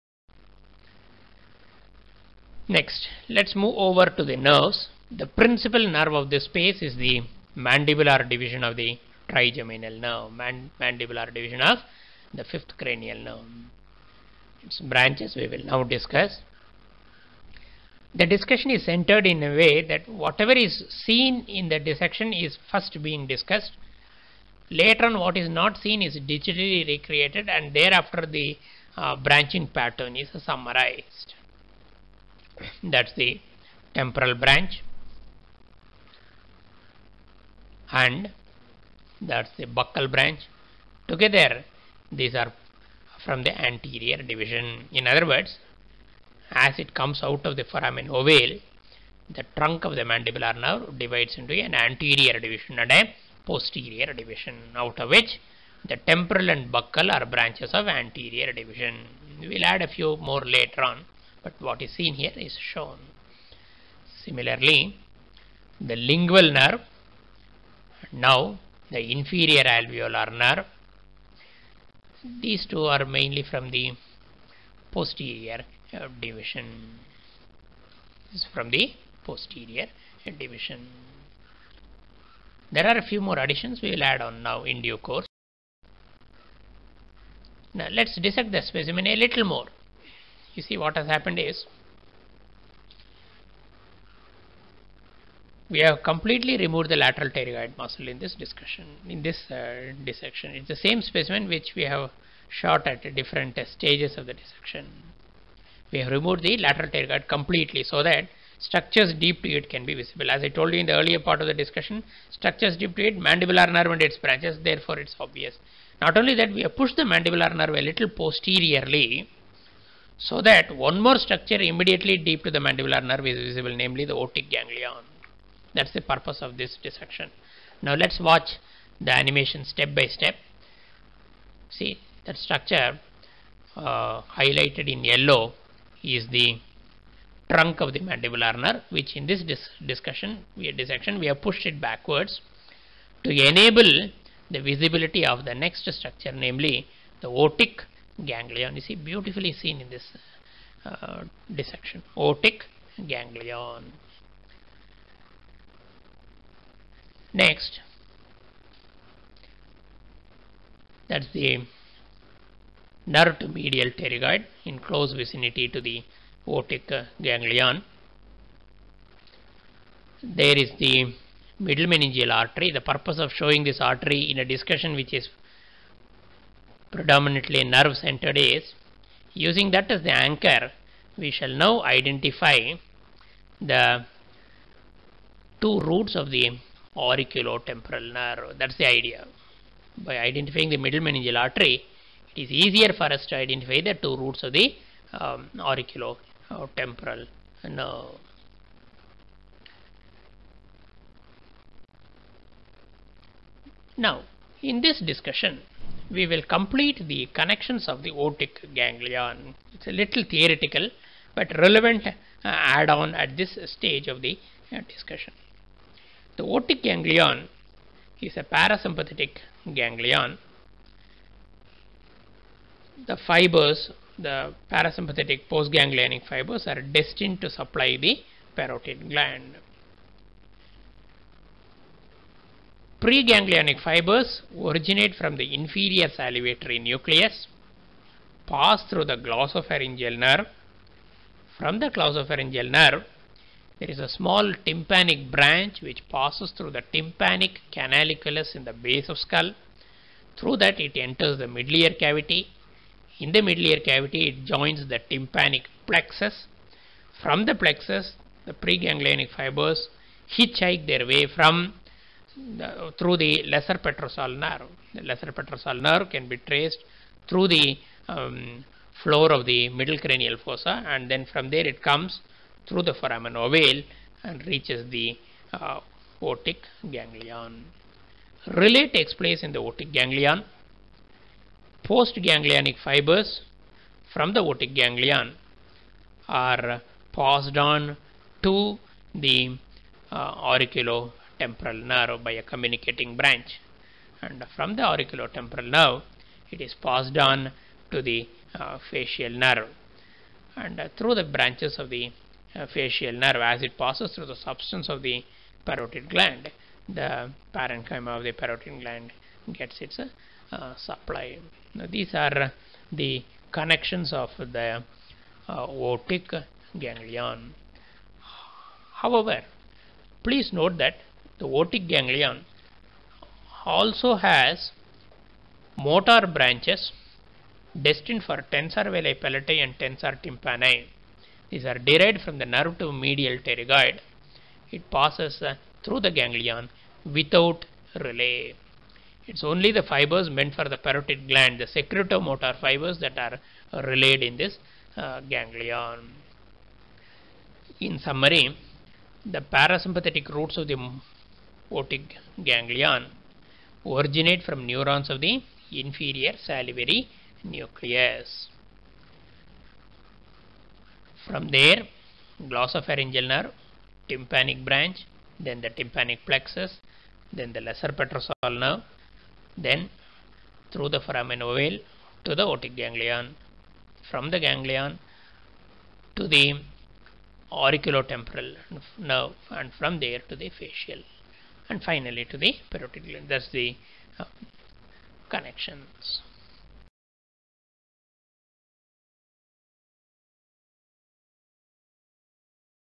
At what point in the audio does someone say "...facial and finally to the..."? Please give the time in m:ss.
6:20.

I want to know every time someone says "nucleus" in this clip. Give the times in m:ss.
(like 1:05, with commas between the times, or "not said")
3:56, 5:57.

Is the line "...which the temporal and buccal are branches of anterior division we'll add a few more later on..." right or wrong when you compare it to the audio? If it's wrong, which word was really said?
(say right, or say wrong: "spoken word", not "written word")
right.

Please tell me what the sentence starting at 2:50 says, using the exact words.
There is the middle meningeal artery.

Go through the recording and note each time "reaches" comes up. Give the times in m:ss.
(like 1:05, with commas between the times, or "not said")
4:34.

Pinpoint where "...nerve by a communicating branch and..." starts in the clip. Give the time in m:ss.
4:51.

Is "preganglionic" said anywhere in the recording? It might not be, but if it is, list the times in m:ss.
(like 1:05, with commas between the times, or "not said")
3:53, 4:18.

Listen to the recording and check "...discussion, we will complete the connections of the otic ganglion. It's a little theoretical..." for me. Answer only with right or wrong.
right.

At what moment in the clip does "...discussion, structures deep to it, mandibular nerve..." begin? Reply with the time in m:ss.
1:51.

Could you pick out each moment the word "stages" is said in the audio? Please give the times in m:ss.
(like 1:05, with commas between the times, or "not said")
1:43, 3:33.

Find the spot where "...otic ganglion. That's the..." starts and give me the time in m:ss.
2:04.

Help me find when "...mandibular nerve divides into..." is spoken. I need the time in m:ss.
0:50.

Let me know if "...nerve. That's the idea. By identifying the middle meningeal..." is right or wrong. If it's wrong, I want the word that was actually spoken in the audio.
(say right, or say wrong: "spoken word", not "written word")
right.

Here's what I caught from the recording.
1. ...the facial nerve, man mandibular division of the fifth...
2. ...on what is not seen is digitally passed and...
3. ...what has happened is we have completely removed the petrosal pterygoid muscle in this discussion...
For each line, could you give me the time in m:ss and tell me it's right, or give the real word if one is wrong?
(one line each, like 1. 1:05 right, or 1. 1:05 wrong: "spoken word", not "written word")
1. 0:08 wrong: "trigeminal", not "facial"
2. 0:25 wrong: "recreated", not "passed"
3. 1:30 wrong: "lateral", not "petrosal".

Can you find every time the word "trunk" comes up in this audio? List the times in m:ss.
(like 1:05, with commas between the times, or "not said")
0:49, 2:17.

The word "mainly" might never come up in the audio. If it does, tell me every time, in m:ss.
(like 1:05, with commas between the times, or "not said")
1:13.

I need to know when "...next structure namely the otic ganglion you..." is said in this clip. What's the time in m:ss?
2:25.